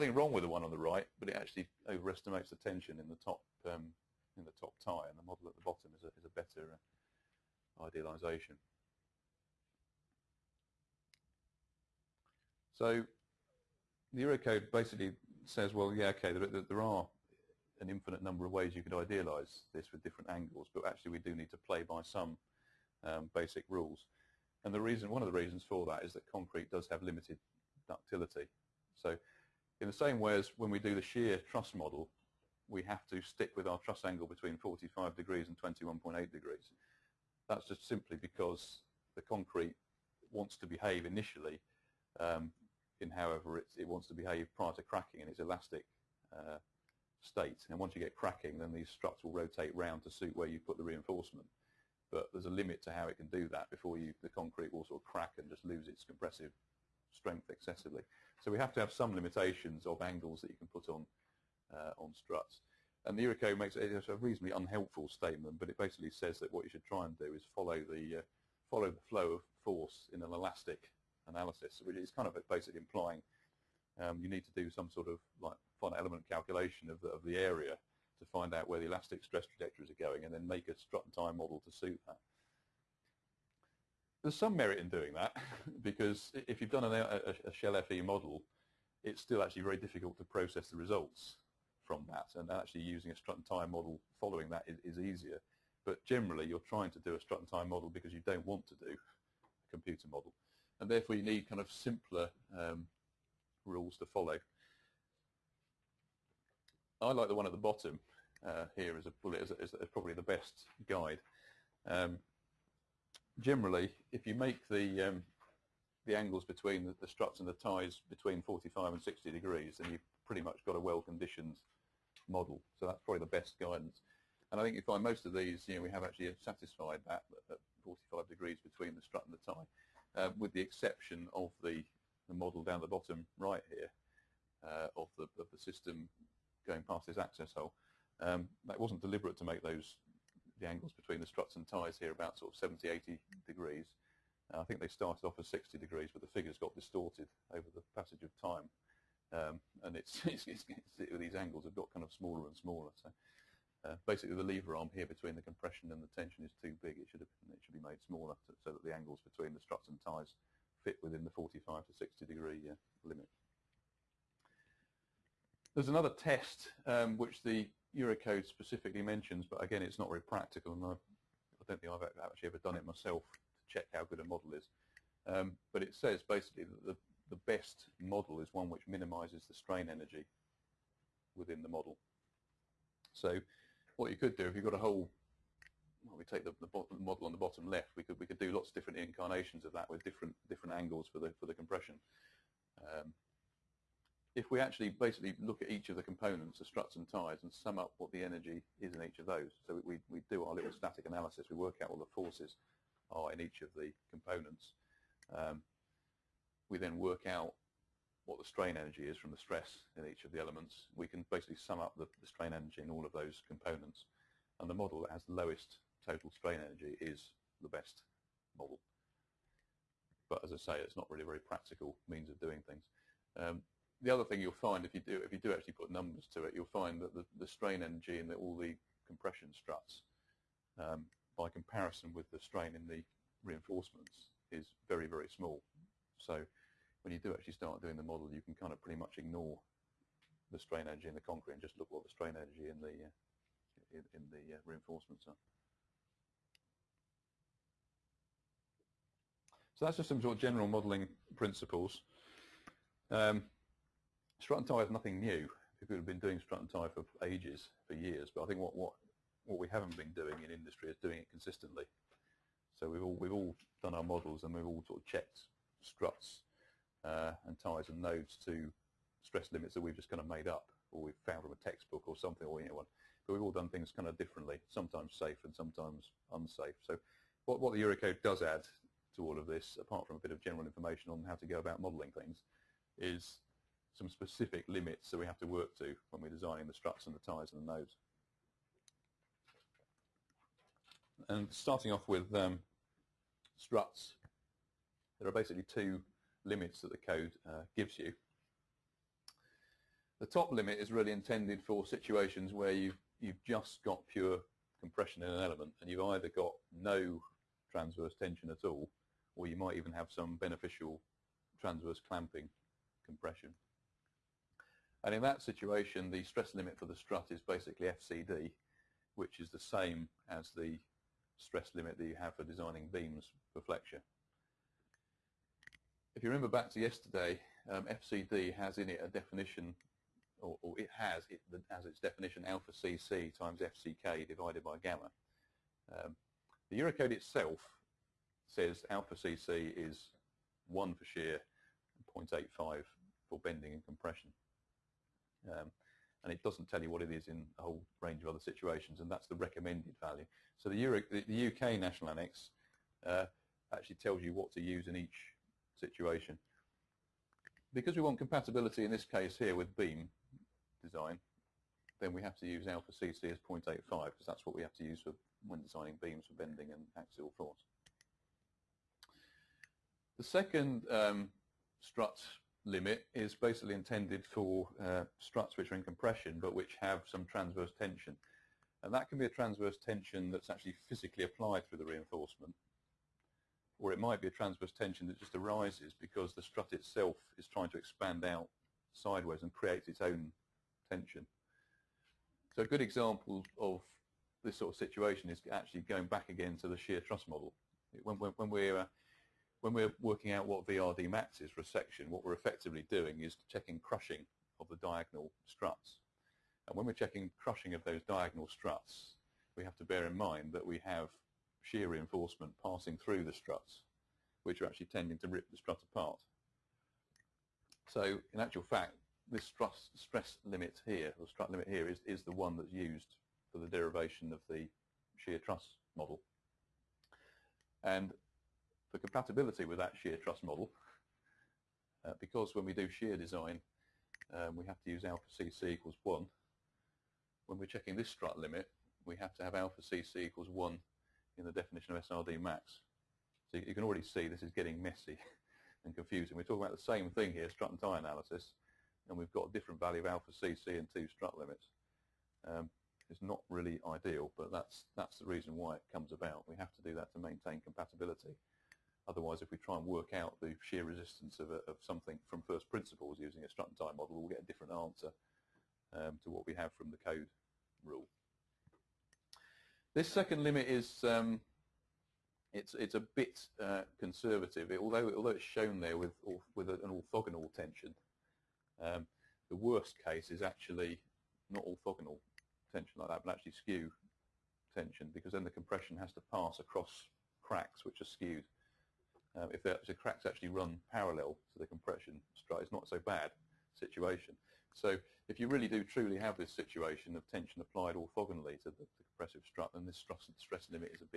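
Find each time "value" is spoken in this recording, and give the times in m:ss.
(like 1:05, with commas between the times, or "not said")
5:49, 7:29.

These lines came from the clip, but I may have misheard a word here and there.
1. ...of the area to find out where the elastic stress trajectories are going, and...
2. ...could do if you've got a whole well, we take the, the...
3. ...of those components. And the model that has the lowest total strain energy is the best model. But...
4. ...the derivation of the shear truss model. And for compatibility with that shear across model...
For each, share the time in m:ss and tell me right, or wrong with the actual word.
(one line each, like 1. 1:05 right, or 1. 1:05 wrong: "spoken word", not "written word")
1. 1:17 right
2. 3:04 right
3. 3:33 right
4. 7:03 wrong: "truss", not "across".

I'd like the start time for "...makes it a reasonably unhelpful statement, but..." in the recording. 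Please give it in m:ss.
1:03.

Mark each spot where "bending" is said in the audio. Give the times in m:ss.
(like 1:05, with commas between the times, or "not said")
5:43, 6:06.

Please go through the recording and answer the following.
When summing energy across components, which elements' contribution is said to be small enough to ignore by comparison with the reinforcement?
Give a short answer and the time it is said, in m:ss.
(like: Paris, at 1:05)
Compression struts, at 3:49.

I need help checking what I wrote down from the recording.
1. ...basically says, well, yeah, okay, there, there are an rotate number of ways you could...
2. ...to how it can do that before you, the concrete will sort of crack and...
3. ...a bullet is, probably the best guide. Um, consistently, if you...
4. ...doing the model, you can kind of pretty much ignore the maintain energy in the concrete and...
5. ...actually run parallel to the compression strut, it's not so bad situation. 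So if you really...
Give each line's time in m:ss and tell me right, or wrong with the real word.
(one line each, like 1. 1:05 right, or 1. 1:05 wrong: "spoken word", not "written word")
1. 0:14 wrong: "infinite", not "rotate"
2. 0:52 right
3. 1:49 wrong: "generally", not "consistently"
4. 3:57 wrong: "strain", not "maintain"
5. 8:10 right.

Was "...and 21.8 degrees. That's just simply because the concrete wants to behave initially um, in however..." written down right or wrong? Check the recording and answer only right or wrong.
right.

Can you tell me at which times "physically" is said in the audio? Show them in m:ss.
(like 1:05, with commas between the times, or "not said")
6:20.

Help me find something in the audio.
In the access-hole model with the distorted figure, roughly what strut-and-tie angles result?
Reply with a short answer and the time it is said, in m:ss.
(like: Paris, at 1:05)
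70, 80 degrees, at 2:22.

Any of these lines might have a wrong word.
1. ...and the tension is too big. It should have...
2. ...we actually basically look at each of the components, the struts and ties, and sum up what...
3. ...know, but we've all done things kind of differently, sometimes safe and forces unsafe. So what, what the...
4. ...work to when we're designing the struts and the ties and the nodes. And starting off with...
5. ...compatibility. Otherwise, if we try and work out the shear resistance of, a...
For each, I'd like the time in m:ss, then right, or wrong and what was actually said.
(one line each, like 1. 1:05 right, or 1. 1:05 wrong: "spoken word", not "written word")
1. 2:35 right
2. 3:14 right
3. 4:32 wrong: "sometimes", not "forces"
4. 4:45 right
5. 7:37 right.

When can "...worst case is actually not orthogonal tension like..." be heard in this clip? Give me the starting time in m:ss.
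7:59.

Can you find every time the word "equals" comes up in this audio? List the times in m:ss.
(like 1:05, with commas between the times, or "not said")
7:15, 7:20.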